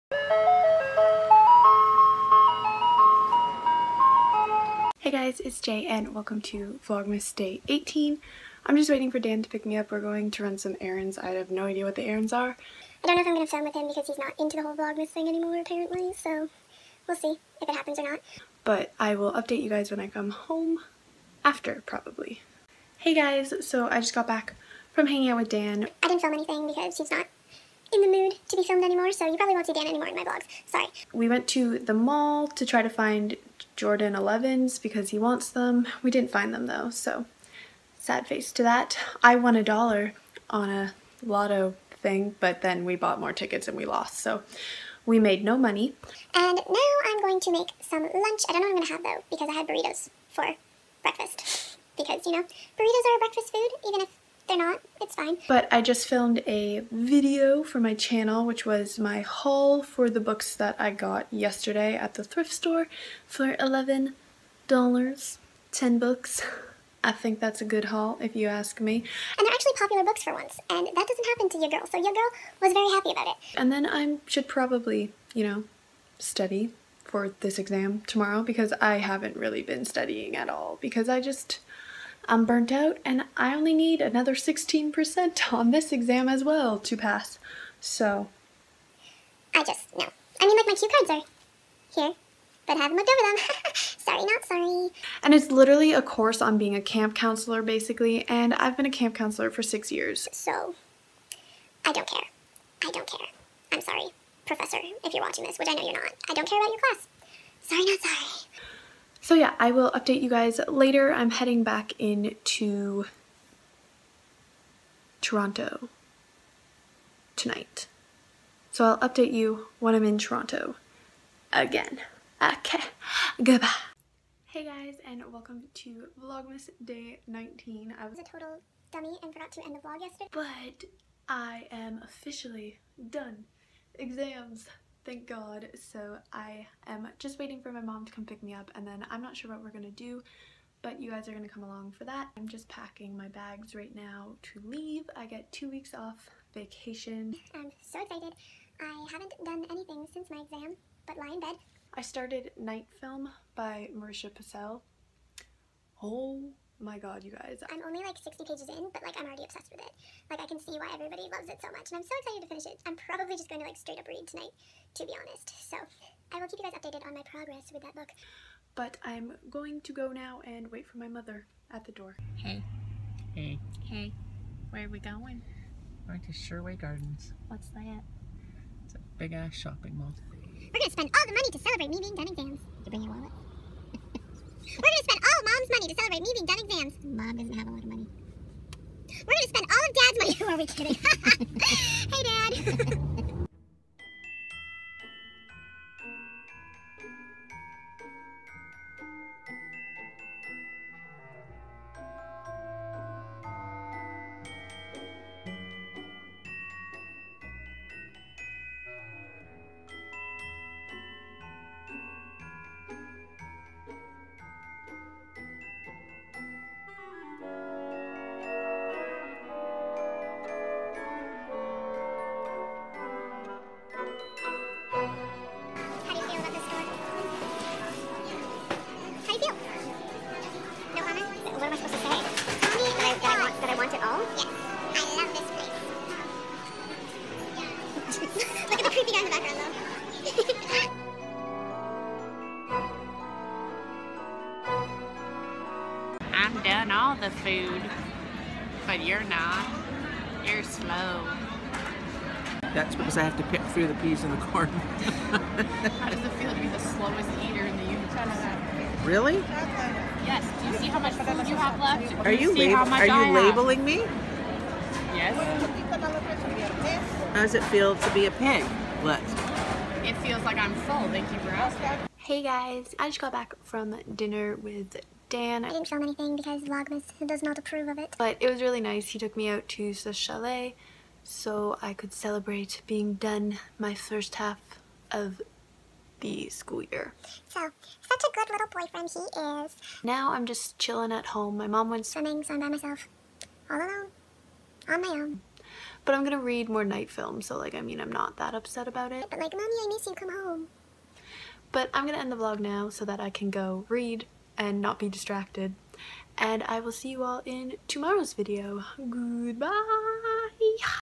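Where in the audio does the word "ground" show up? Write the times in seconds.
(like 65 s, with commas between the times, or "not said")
not said.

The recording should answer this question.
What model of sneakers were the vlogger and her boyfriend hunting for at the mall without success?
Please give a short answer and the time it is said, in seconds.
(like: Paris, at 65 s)
Jordan 11s, at 33 s.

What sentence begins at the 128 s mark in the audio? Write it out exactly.
I was a total dummy and forgot to end the vlog yesterday.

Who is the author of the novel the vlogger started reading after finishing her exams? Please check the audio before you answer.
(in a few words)
Marisha Pessl.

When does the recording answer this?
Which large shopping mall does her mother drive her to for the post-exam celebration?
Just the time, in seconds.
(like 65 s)
176 s.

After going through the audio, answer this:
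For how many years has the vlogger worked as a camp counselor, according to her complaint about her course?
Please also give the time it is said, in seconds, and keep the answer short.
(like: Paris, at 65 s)
6, at 99 s.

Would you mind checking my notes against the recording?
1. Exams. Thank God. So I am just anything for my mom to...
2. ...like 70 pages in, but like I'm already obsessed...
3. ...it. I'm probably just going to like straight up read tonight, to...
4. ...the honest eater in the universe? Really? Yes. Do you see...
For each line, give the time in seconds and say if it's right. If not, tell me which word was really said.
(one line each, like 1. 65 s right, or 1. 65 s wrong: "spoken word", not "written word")
1. 133 s wrong: "waiting", not "anything"
2. 158 s wrong: "60", not "70"
3. 162 s right
4. 256 s wrong: "slowest", not "honest".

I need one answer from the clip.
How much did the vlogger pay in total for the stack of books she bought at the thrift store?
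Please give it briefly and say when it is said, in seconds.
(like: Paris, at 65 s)
$11, at 63 s.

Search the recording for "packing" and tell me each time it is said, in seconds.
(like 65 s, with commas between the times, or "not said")
142 s.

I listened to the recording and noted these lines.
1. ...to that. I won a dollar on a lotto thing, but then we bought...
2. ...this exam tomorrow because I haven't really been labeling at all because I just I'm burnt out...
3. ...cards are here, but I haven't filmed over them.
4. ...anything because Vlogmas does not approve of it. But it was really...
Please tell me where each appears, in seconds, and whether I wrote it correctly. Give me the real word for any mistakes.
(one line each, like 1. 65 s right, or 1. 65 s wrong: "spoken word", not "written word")
1. 38 s right
2. 77 s wrong: "studying", not "labeling"
3. 90 s wrong: "looked", not "filmed"
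4. 276 s right.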